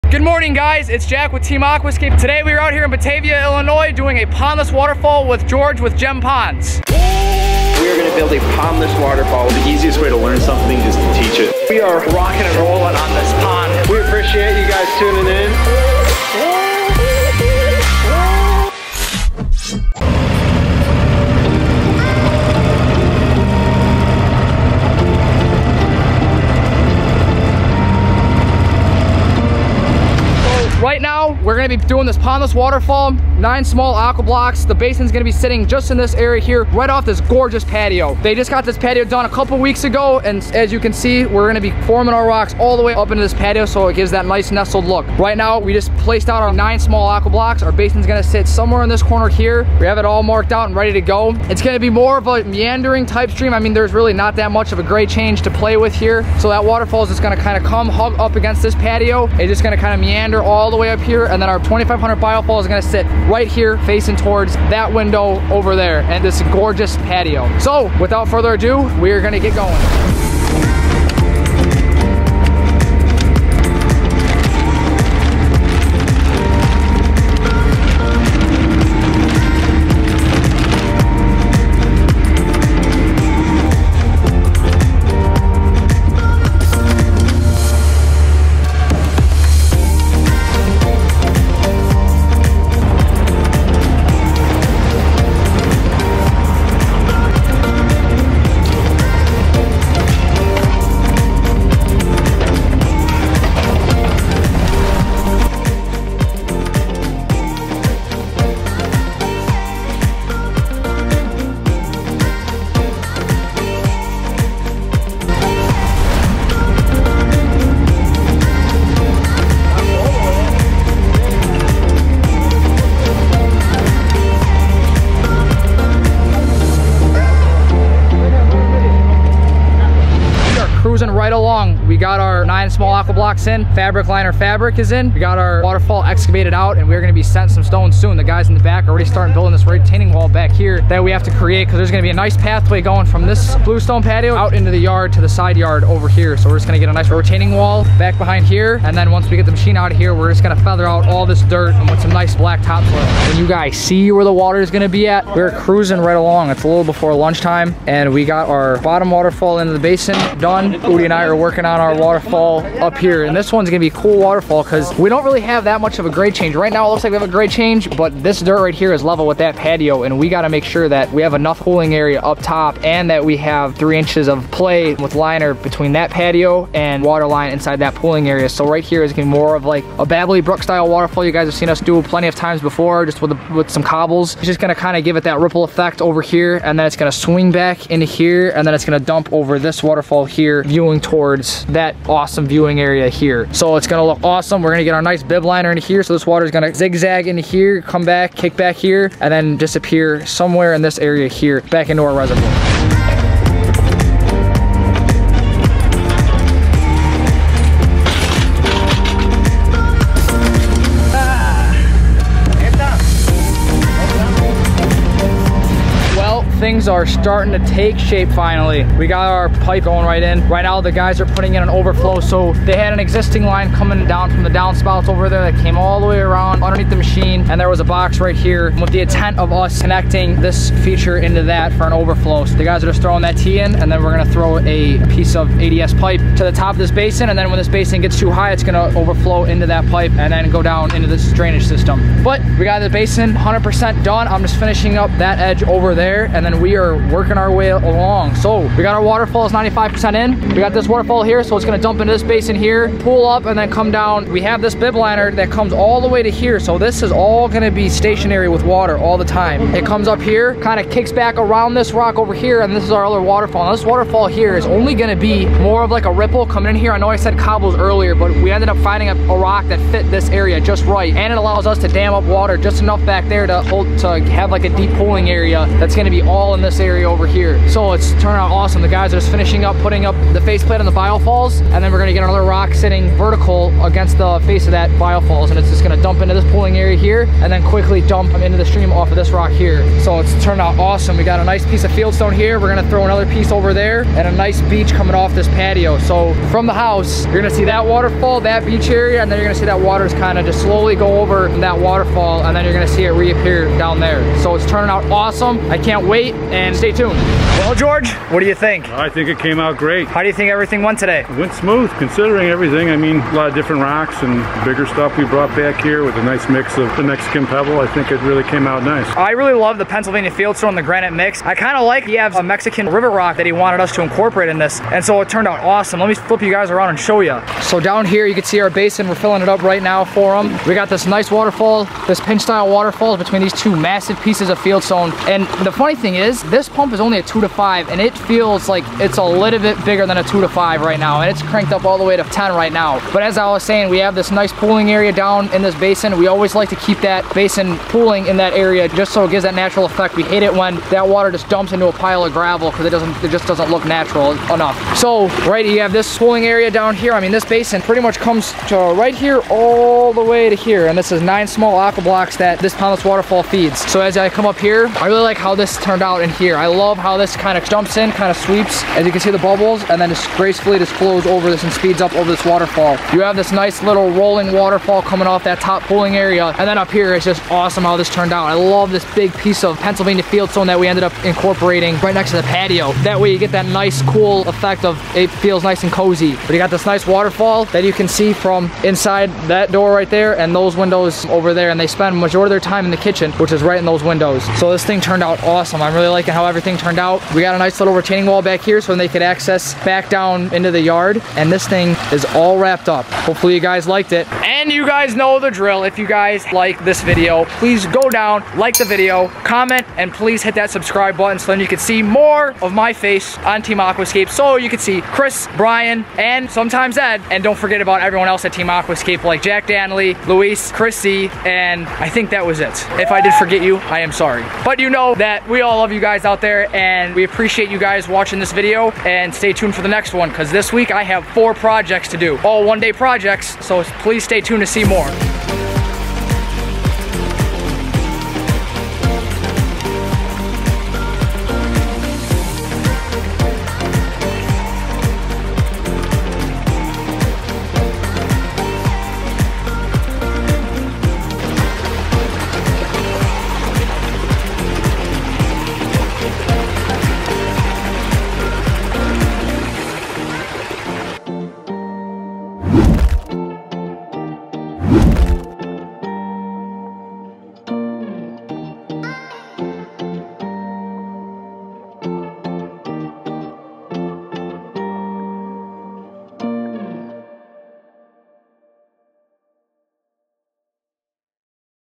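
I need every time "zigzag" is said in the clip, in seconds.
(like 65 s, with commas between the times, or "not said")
196 s.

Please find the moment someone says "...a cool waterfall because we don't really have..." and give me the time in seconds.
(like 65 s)
163 s.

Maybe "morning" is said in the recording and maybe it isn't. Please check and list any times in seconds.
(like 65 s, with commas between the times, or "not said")
0 s.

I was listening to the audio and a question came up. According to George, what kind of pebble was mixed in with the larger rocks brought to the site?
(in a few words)
Mexican Pebble.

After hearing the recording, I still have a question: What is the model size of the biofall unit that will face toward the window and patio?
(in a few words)
2500.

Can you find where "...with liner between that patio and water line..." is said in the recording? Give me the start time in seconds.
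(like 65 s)
174 s.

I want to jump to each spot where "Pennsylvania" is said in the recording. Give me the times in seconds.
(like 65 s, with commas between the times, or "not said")
319 s, 379 s.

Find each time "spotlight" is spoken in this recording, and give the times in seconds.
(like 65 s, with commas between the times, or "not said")
not said.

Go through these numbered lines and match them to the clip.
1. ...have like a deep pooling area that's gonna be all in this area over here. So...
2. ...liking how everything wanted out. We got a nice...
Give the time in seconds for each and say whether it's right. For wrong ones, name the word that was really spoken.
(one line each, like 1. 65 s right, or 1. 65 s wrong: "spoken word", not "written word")
1. 274 s right
2. 396 s wrong: "turned", not "wanted".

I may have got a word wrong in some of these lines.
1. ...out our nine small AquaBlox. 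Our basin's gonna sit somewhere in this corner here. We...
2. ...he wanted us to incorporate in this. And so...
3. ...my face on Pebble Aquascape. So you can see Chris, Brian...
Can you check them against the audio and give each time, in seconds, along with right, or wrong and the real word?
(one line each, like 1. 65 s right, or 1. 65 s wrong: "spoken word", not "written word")
1. 46 s right
2. 323 s right
3. 412 s wrong: "Team", not "Pebble".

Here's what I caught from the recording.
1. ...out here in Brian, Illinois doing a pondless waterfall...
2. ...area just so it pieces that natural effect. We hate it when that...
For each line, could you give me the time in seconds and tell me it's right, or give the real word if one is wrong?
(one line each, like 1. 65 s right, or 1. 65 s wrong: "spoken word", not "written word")
1. 2 s wrong: "Batavia", not "Brian"
2. 348 s wrong: "gives", not "pieces".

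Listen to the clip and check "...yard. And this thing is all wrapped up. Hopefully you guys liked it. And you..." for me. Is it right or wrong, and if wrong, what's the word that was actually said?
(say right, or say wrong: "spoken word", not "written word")
right.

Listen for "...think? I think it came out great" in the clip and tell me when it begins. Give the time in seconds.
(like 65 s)
308 s.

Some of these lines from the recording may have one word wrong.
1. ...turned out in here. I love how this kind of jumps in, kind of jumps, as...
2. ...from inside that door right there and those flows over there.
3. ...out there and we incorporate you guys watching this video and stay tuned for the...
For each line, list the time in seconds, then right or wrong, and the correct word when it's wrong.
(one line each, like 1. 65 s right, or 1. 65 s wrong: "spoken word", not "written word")
1. 365 s wrong: "sweeps", not "jumps"
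2. 388 s wrong: "windows", not "flows"
3. 426 s wrong: "appreciate", not "incorporate".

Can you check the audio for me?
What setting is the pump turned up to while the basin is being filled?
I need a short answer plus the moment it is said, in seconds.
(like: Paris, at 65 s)
10, at 342 s.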